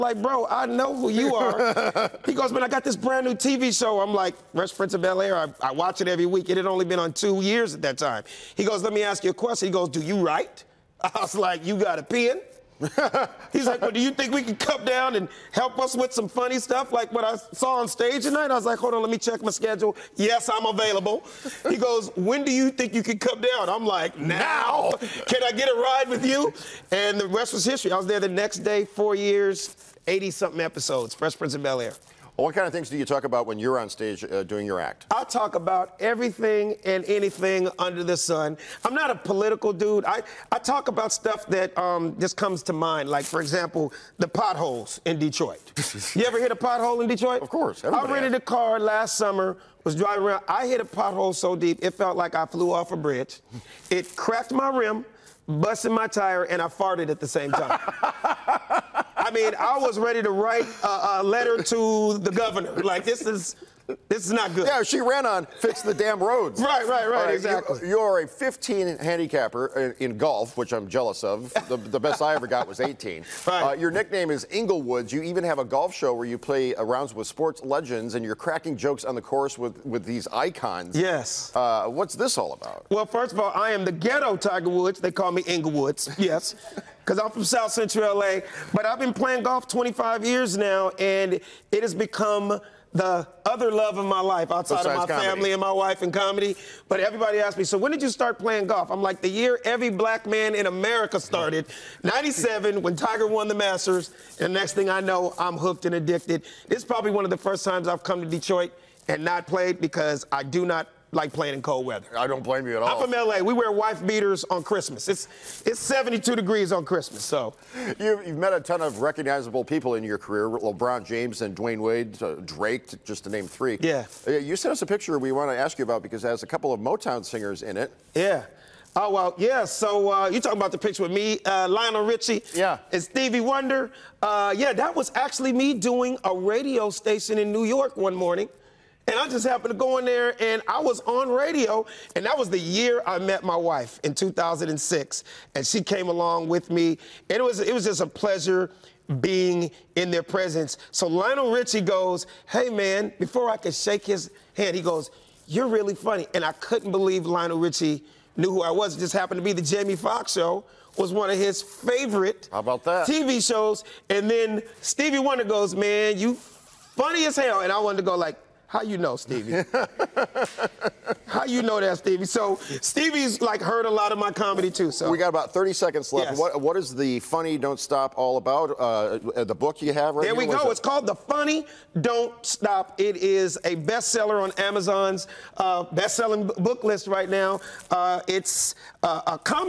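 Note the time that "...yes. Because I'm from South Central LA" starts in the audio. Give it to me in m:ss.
1:26.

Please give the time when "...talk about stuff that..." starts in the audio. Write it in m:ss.
0:40.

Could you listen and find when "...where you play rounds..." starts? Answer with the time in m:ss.
1:16.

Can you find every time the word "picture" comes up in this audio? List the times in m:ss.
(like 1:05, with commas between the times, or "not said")
2:04, 2:10.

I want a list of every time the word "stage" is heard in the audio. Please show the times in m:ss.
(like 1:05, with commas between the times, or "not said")
0:17, 0:33.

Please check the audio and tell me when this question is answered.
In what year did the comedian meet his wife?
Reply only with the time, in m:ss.
2:24.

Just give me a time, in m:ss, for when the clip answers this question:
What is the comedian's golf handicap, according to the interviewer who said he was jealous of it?
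1:08.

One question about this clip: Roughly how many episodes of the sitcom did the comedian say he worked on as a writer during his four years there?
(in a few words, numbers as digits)
80-something.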